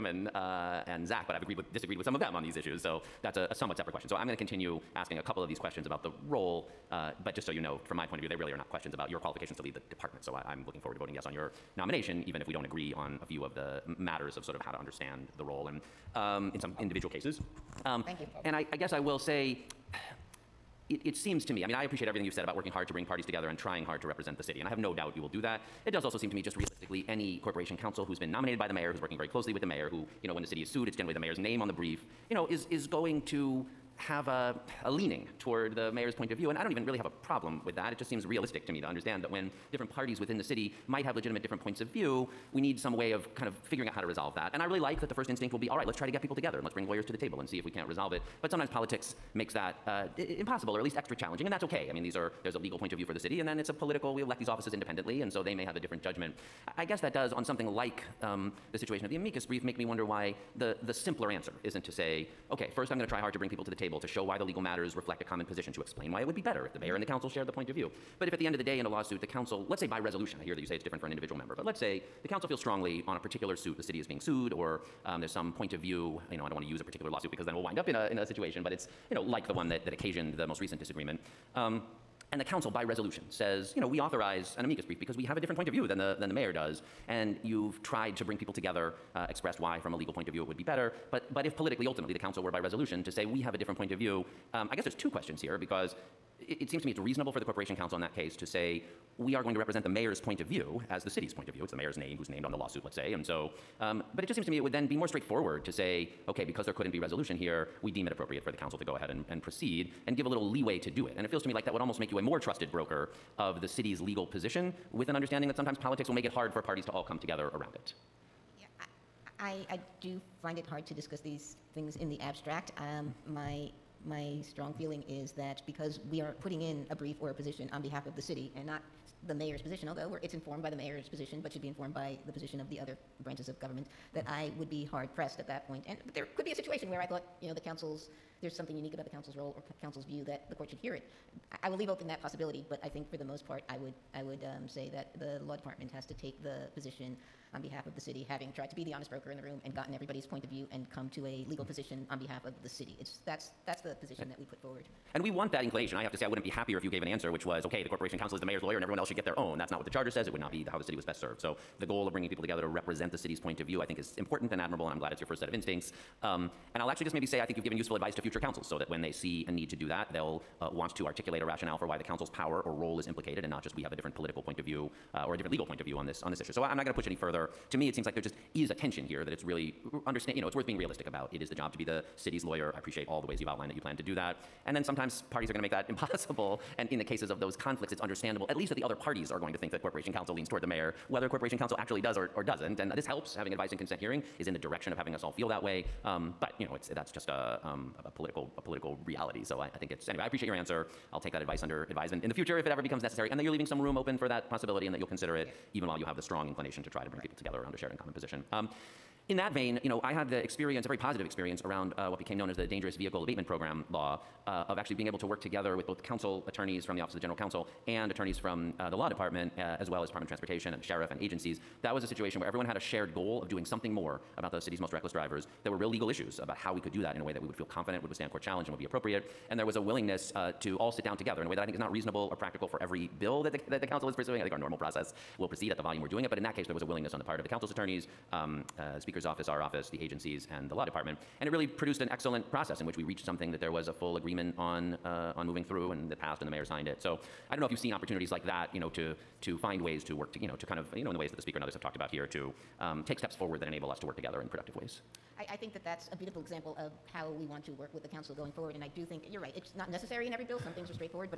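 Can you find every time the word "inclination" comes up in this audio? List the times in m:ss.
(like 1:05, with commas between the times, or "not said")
2:35, 3:26.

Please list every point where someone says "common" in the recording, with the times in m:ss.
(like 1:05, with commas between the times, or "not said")
1:05, 3:27.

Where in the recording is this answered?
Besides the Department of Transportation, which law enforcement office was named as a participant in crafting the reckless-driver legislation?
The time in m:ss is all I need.
3:40.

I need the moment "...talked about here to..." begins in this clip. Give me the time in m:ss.
4:11.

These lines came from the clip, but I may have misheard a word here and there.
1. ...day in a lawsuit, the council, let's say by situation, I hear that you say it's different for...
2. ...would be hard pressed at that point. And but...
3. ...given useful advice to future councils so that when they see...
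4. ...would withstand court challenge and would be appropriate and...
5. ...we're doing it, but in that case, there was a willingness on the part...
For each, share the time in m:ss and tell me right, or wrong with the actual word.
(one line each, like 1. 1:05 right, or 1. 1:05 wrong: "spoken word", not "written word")
1. 1:08 wrong: "resolution", not "situation"
2. 2:14 right
3. 2:47 right
4. 3:48 right
5. 3:56 right.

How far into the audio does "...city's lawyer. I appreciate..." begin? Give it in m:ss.
3:02.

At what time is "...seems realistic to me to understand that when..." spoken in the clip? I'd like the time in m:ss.
0:38.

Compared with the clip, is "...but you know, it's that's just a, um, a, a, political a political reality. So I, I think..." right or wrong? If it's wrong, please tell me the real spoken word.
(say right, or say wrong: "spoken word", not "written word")
right.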